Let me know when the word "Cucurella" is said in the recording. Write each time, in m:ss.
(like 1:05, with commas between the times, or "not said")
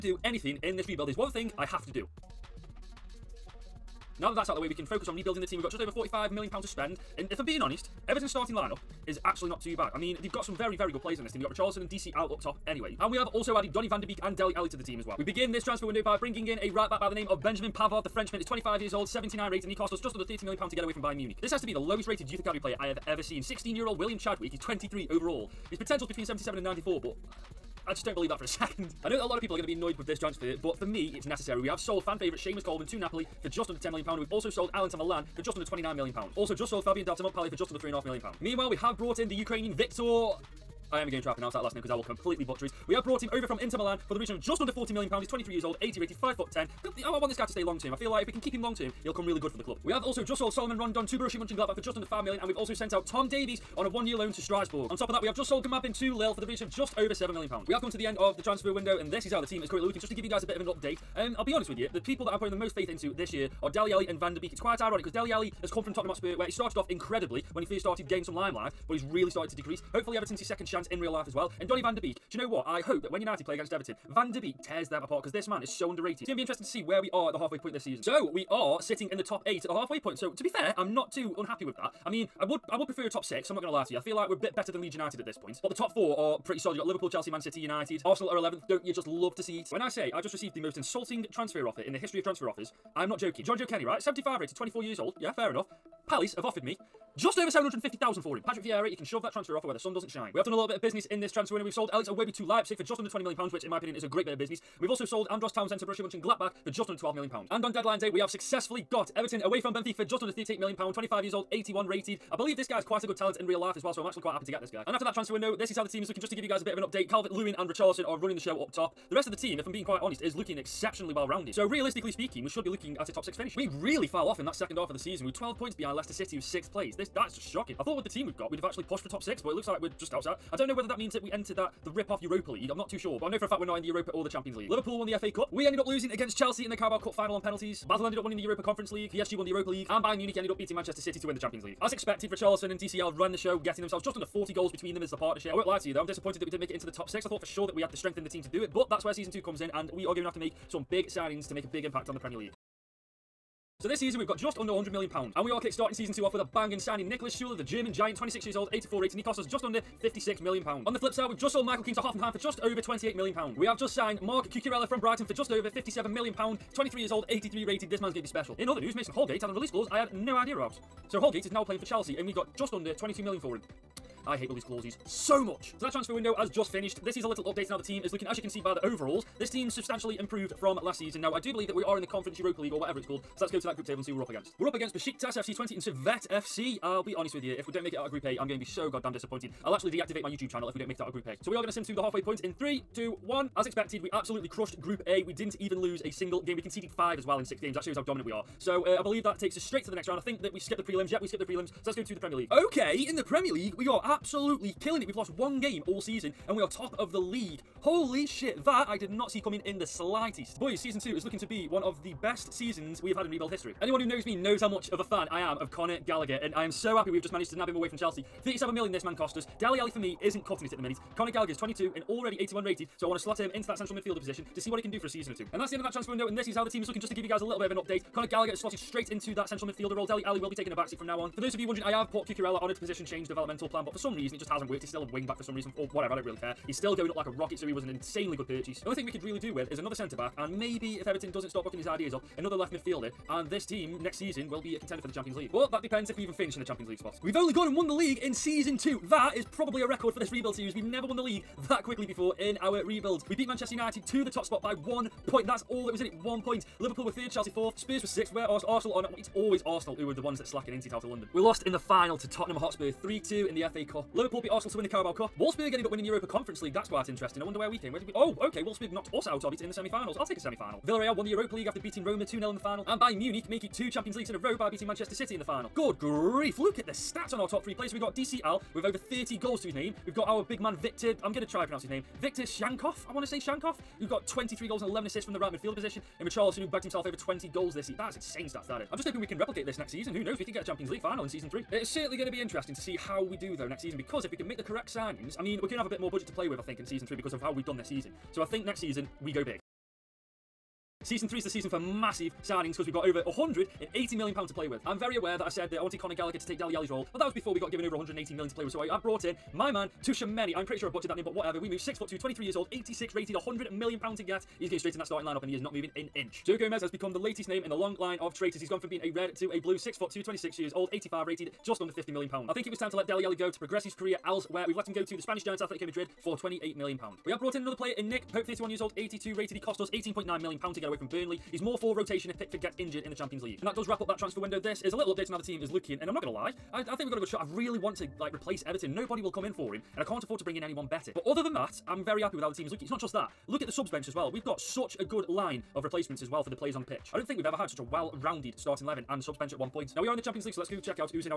2:44, 3:52.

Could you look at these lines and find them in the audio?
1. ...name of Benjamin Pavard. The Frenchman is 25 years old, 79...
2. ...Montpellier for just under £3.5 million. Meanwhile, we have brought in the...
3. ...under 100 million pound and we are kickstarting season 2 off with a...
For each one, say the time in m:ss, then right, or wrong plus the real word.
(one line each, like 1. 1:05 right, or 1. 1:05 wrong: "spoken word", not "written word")
1. 0:17 right
2. 0:37 right
3. 2:34 right.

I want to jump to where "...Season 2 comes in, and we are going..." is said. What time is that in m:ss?
2:29.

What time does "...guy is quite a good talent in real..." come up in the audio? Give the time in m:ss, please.
1:52.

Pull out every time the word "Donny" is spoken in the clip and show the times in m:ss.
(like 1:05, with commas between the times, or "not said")
0:13, 1:11.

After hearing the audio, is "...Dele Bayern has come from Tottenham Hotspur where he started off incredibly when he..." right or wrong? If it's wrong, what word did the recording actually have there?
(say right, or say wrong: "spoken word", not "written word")
wrong: "Alli", not "Bayern".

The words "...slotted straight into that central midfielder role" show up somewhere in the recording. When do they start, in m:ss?
3:48.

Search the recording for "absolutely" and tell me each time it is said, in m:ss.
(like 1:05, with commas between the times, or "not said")
3:14, 3:24.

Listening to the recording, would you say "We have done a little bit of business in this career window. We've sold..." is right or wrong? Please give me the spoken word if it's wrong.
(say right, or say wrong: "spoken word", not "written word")
wrong: "transfer", not "career".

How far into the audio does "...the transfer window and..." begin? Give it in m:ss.
0:58.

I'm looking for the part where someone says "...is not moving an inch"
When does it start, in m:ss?
5:15.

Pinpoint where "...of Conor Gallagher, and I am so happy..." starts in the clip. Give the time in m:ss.
3:35.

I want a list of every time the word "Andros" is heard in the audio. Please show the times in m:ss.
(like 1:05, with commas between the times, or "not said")
1:45.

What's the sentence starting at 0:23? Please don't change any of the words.
16-year-old William Chadwick, he's 23 overall.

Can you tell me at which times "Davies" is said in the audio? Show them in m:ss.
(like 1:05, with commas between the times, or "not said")
0:53.